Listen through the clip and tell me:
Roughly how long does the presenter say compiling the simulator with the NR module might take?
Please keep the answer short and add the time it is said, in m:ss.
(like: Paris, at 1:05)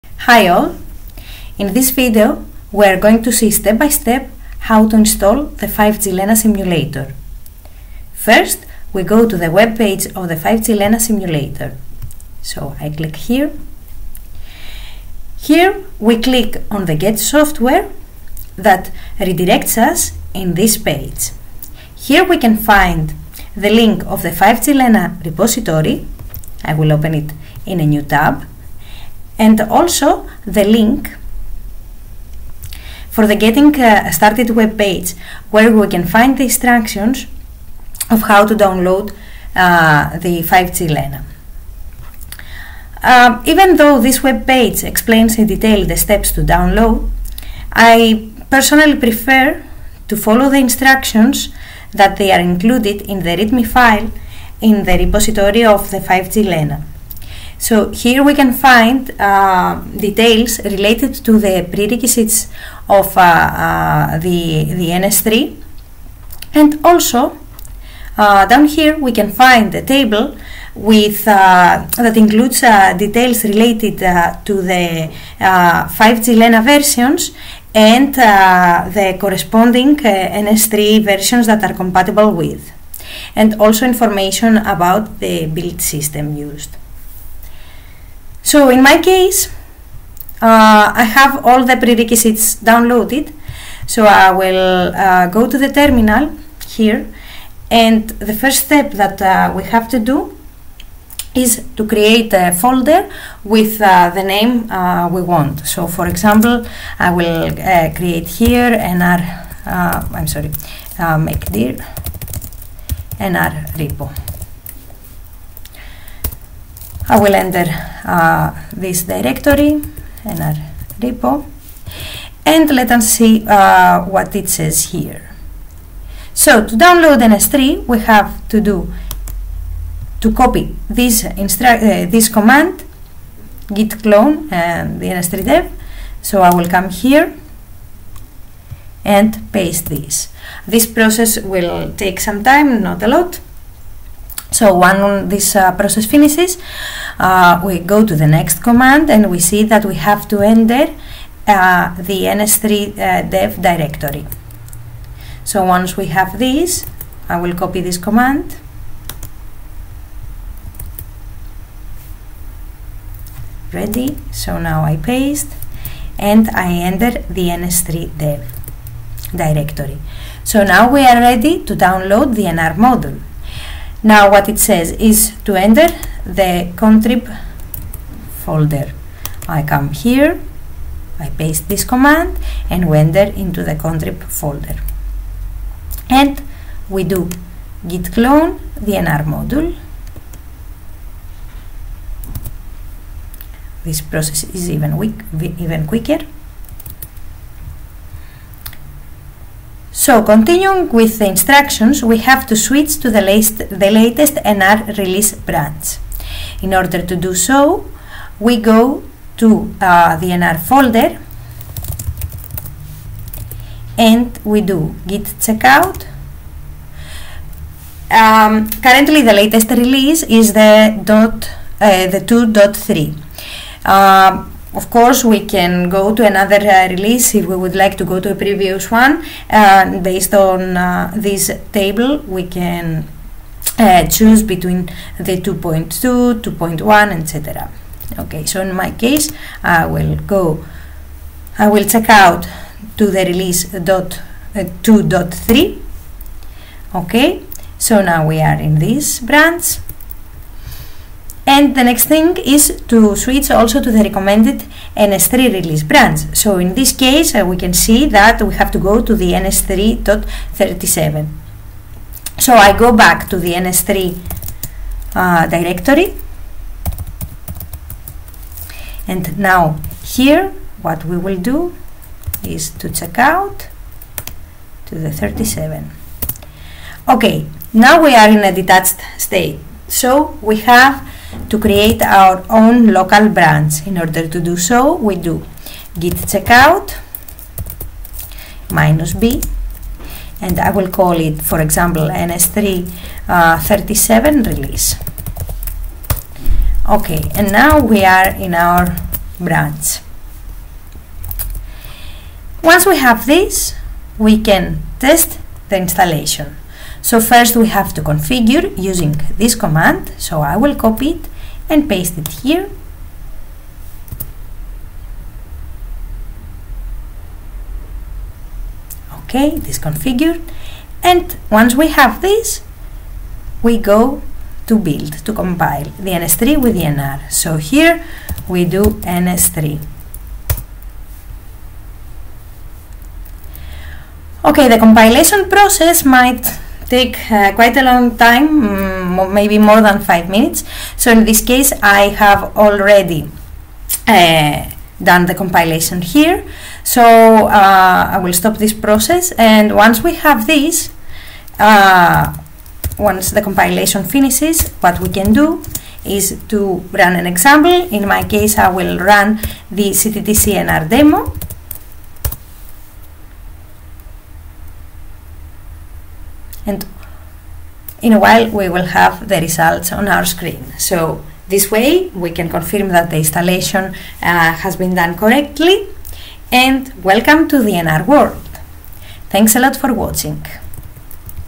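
more than 5 minutes, at 5:39.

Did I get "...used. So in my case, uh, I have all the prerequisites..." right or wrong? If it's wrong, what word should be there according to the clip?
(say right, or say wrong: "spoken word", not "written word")
right.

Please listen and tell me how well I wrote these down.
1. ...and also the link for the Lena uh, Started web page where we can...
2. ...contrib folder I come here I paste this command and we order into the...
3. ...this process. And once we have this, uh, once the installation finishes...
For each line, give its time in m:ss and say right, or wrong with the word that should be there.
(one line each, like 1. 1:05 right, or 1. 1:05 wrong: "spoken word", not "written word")
1. 0:29 wrong: "Getting", not "Lena"
2. 2:56 wrong: "enter", not "order"
3. 5:48 wrong: "compilation", not "installation".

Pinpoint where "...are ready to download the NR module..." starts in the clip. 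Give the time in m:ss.
2:51.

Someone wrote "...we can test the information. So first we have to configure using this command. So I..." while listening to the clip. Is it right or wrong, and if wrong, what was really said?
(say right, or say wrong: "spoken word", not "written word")
wrong: "installation", not "information".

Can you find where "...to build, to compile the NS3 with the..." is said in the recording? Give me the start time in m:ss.
5:24.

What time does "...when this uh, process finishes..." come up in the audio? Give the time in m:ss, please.
2:24.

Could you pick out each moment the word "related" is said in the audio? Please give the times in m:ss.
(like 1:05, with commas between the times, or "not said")
1:00, 1:13.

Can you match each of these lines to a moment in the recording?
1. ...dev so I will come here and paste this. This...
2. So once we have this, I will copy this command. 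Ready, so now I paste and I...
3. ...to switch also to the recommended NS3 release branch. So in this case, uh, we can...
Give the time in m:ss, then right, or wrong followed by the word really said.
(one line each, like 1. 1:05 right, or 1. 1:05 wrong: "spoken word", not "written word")
1. 2:15 right
2. 2:35 right
3. 4:12 right.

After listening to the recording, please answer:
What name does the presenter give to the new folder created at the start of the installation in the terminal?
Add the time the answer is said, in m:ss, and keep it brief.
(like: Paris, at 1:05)
nr repo, at 1:53.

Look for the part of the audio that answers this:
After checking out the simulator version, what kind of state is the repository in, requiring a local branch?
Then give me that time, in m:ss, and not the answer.
4:38.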